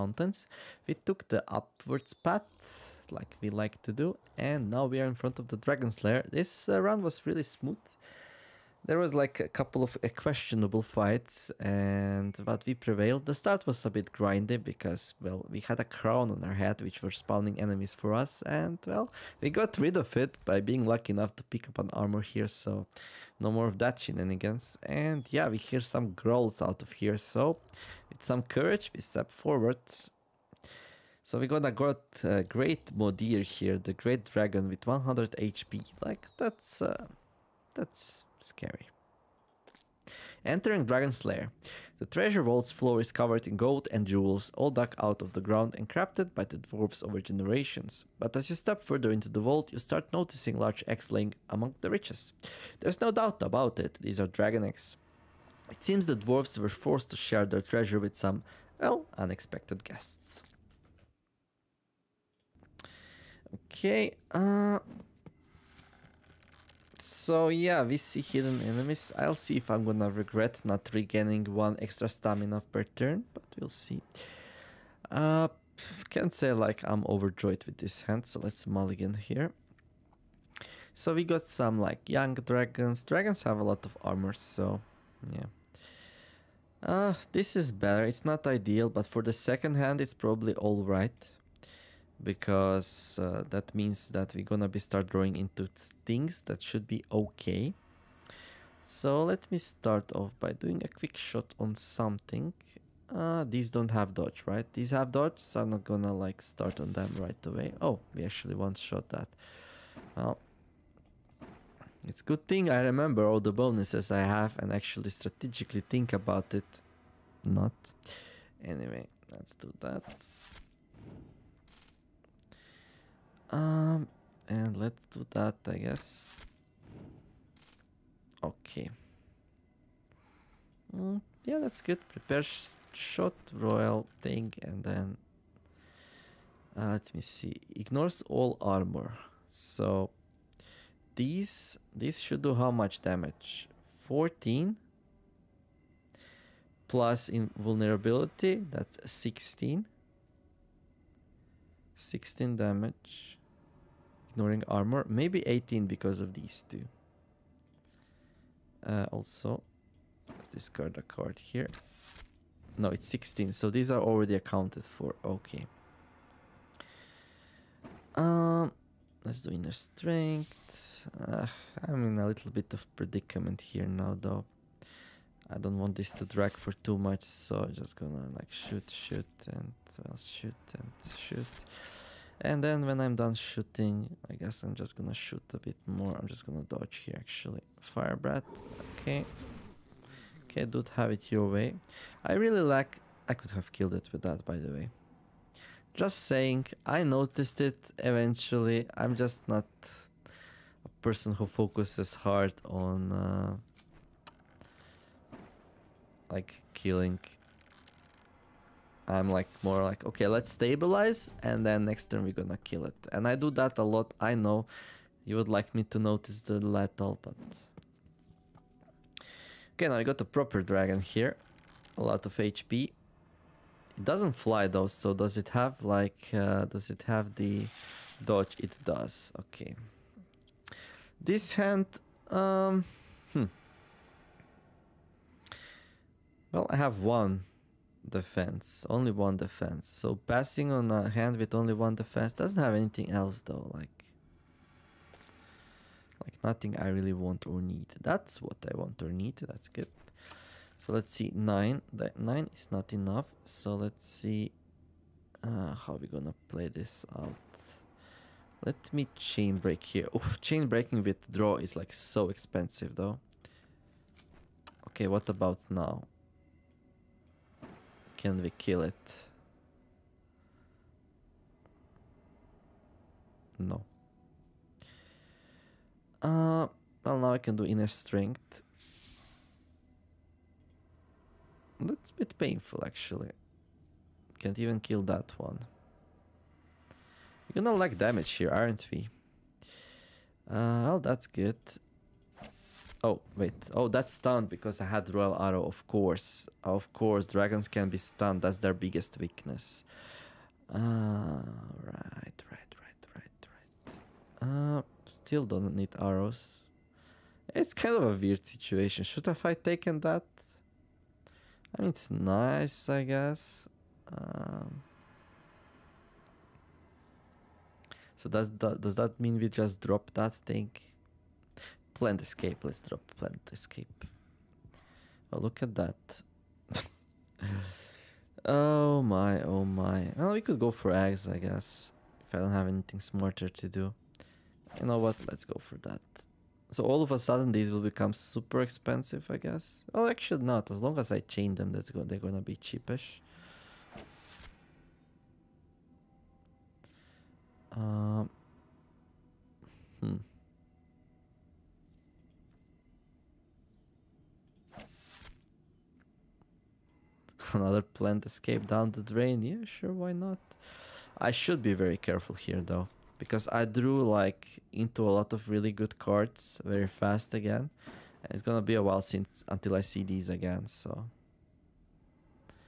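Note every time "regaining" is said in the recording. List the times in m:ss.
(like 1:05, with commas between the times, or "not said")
1:10.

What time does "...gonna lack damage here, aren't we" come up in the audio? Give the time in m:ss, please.
4:47.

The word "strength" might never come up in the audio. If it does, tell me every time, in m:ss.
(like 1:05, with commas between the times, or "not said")
2:49, 4:37.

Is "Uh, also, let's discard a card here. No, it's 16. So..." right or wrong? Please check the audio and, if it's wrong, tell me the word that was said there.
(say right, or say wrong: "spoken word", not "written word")
right.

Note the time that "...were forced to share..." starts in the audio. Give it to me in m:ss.
0:56.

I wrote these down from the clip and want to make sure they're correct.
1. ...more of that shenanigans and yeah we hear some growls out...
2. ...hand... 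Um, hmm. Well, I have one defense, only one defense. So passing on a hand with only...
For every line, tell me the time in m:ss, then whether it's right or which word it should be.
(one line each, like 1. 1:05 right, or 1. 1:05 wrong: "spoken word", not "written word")
1. 0:23 right
2. 3:51 right.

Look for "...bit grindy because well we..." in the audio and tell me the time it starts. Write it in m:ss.
0:13.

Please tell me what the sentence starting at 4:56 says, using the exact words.
Of course, dragons can be stunned.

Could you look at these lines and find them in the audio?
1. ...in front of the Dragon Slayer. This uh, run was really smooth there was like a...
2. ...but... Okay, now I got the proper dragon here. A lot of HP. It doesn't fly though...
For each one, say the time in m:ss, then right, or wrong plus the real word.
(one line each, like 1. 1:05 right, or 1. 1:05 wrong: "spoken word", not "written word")
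1. 0:05 right
2. 3:37 right.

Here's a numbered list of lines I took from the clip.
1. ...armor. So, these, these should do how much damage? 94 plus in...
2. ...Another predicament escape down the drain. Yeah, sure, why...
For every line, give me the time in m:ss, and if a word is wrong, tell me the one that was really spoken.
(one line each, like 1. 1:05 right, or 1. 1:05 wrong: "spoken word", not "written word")
1. 2:18 wrong: "14", not "94"
2. 5:57 wrong: "plant", not "predicament".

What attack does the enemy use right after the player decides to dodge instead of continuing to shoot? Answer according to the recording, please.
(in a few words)
Fire breath.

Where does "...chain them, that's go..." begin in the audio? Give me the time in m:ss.
5:41.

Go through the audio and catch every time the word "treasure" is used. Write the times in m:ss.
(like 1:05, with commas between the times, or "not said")
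0:42, 0:57.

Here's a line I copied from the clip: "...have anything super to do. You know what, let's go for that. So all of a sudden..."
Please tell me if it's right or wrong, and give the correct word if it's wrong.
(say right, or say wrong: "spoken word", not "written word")
wrong: "smarter", not "super".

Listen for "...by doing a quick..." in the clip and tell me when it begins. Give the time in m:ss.
1:40.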